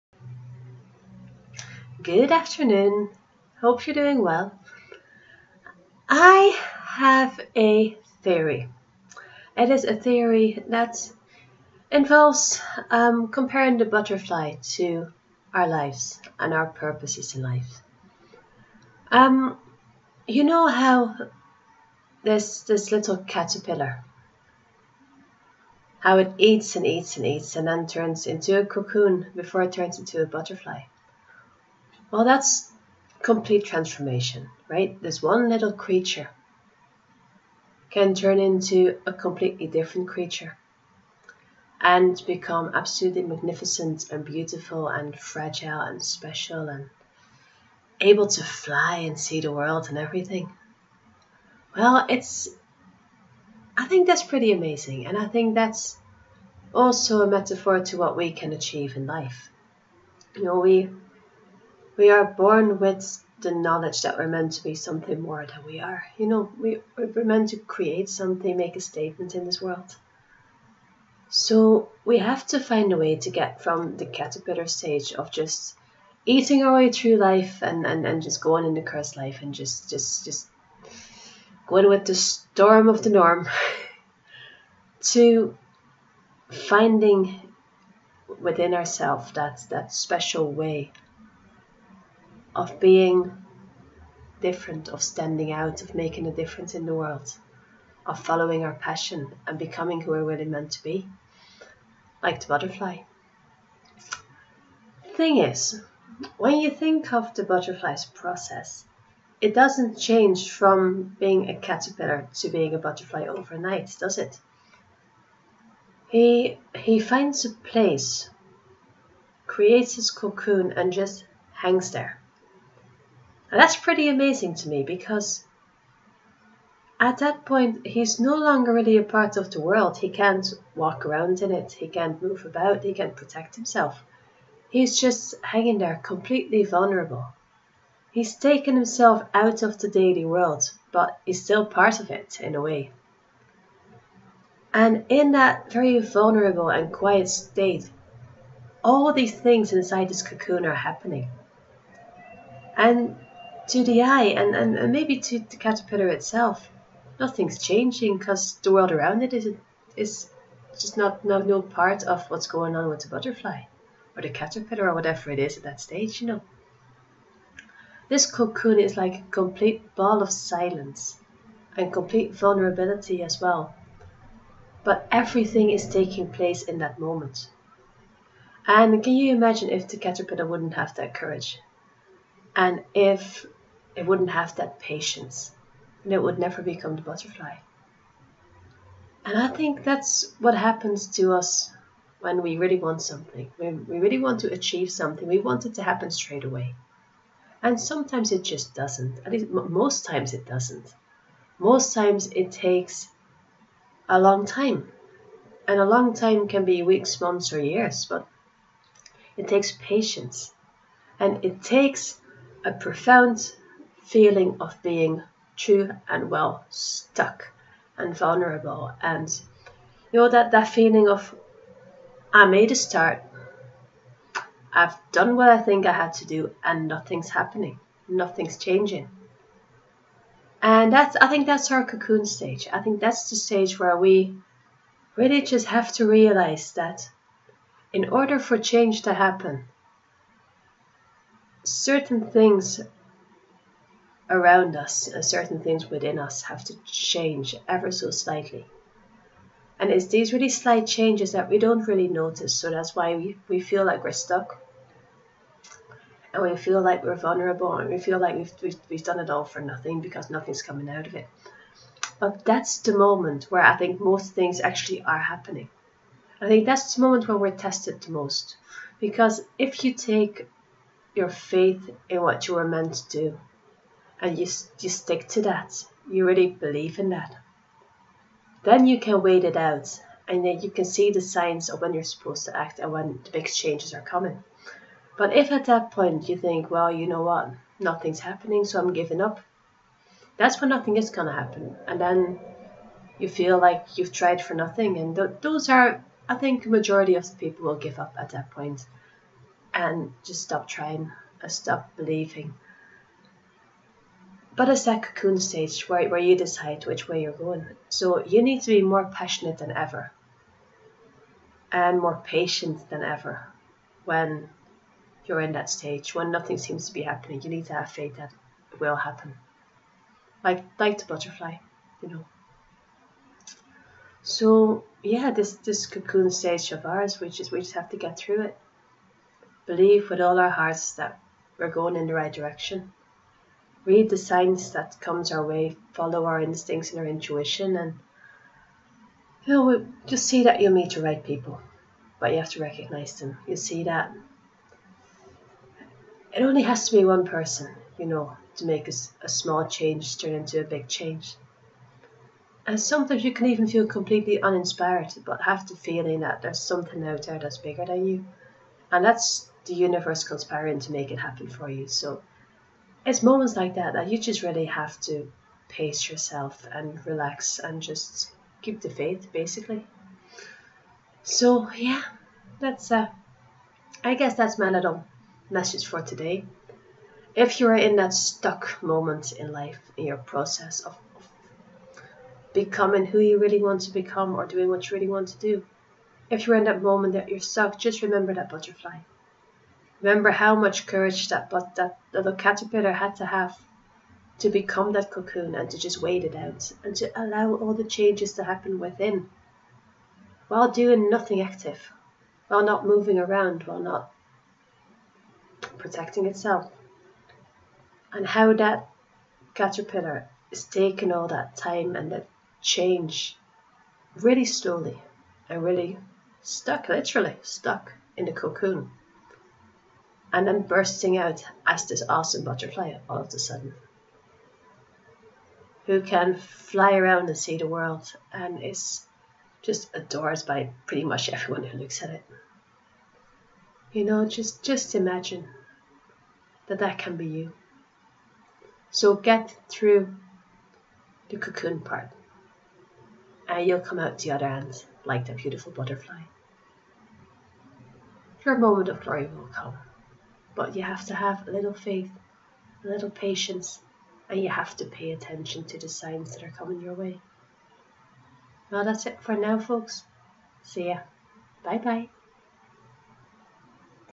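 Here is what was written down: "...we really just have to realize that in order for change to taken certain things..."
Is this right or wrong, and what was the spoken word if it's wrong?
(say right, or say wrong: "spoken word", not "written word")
wrong: "happen", not "taken".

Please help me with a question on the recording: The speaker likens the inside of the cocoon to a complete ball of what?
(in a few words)
Silence.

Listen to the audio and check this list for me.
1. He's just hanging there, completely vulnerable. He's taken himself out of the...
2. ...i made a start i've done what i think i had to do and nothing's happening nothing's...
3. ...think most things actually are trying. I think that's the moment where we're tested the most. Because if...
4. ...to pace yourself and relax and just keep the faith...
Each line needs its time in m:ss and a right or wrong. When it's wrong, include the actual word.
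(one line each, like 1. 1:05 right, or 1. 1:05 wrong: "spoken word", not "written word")
1. 2:14 right
2. 3:42 right
3. 4:23 wrong: "happening", not "trying"
4. 6:05 right.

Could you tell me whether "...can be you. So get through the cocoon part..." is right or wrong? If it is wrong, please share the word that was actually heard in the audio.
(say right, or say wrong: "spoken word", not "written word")
right.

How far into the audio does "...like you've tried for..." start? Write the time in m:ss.
4:53.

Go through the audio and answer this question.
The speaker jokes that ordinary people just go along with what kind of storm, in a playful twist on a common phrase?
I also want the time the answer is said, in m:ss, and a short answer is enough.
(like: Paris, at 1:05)
The storm of the norm, at 1:22.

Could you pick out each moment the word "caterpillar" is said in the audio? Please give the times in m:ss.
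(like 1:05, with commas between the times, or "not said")
0:23, 1:14, 1:51, 2:35, 2:44, 2:59, 6:32, 6:49.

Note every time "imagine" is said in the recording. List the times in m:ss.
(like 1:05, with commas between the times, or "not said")
2:59, 7:14.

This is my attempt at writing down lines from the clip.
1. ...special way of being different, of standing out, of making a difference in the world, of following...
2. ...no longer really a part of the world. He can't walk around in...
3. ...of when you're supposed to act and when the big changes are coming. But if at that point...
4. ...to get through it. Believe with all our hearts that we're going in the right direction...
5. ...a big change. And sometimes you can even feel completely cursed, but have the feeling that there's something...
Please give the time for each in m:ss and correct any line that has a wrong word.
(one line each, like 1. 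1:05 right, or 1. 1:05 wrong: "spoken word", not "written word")
1. 1:29 right
2. 2:08 right
3. 4:41 right
4. 5:27 right
5. 5:50 wrong: "uninspired", not "cursed".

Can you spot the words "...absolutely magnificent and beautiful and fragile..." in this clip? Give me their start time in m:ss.
0:42.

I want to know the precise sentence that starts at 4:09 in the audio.
And it's these really slight changes that we don't really notice.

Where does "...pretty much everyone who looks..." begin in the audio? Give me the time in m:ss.
7:10.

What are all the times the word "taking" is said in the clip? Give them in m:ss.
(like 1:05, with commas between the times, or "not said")
2:55, 6:50.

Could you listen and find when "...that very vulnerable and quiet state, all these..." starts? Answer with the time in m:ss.
2:25.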